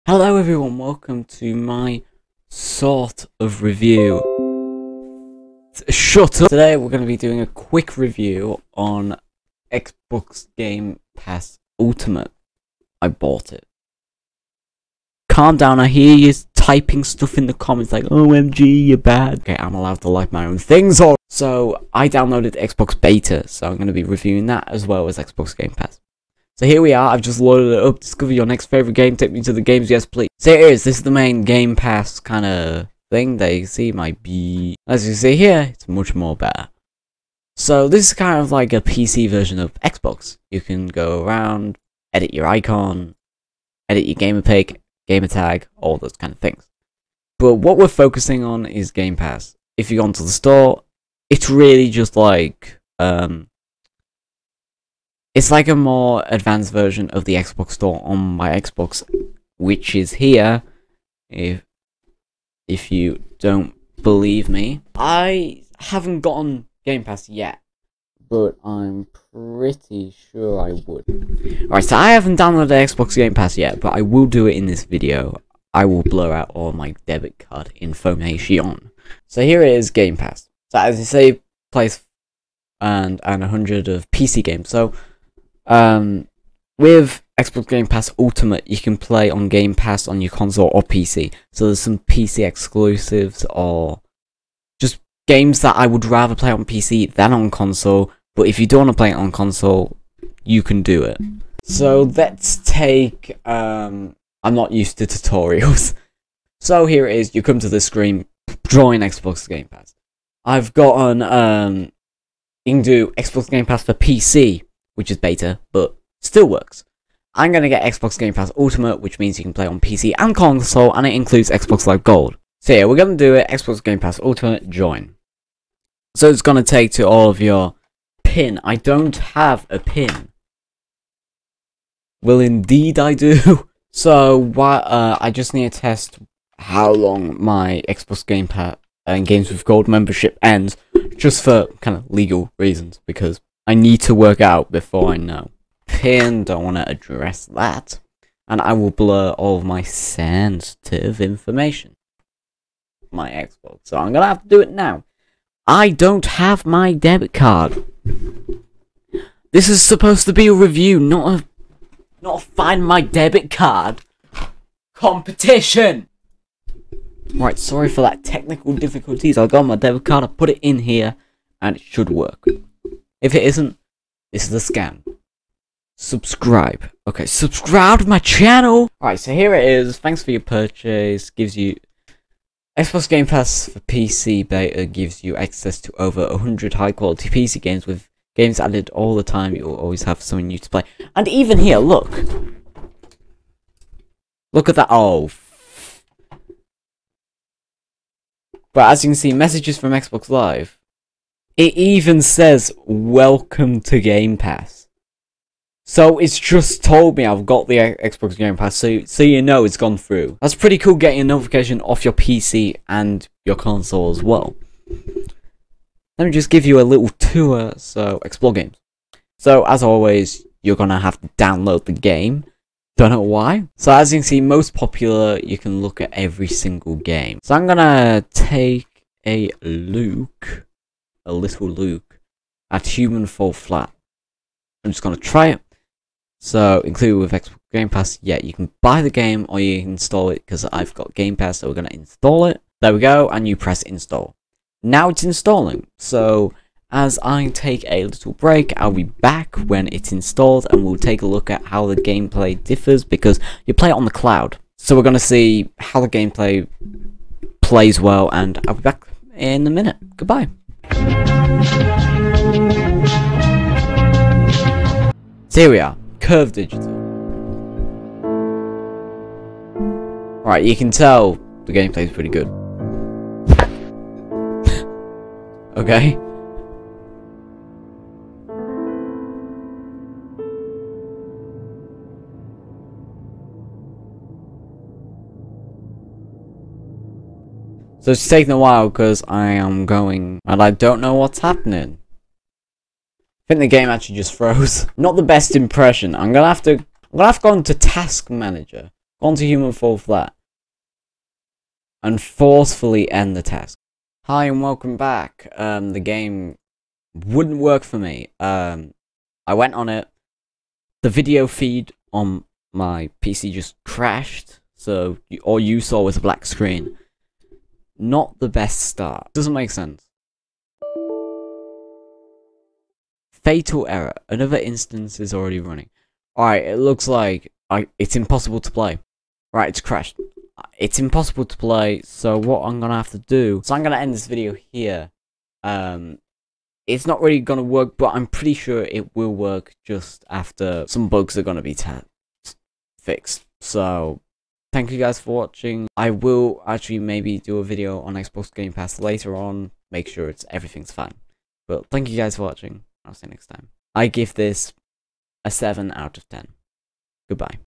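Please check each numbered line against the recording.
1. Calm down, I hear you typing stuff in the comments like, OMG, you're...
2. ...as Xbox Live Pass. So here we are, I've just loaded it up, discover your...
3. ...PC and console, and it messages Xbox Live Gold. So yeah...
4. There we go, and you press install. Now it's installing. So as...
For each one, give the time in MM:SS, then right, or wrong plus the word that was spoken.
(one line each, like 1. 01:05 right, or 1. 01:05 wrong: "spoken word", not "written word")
1. 00:15 right
2. 00:25 wrong: "Game", not "Live"
3. 01:59 wrong: "includes", not "messages"
4. 04:02 right.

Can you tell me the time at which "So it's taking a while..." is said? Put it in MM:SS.
04:48.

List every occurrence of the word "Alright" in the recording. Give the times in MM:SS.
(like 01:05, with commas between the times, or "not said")
01:11, 02:58, 05:26.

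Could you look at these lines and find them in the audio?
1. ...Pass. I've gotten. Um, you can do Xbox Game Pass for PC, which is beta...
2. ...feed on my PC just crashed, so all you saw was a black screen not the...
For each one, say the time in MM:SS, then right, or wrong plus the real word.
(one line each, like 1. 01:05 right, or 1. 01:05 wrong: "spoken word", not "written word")
1. 01:49 right
2. 05:11 right.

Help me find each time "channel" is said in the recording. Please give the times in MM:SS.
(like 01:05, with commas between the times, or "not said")
02:58.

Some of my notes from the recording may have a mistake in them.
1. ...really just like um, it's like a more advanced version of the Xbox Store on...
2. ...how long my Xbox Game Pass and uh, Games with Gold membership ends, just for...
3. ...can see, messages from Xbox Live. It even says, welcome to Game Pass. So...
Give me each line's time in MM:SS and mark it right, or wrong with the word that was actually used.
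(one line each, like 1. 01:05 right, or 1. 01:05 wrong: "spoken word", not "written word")
1. 00:51 right
2. 02:16 right
3. 03:19 right.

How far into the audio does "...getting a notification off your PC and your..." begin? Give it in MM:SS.
03:30.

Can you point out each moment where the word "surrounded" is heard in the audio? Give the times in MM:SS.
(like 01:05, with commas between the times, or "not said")
not said.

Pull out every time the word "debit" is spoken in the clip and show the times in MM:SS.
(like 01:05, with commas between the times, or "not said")
01:17, 02:36, 02:42, 02:49.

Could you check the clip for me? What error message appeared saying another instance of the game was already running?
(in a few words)
Fatal error.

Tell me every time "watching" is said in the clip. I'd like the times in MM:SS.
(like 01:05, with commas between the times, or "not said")
05:45, 05:52.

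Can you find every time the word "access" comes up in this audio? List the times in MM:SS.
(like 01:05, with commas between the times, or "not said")
03:05.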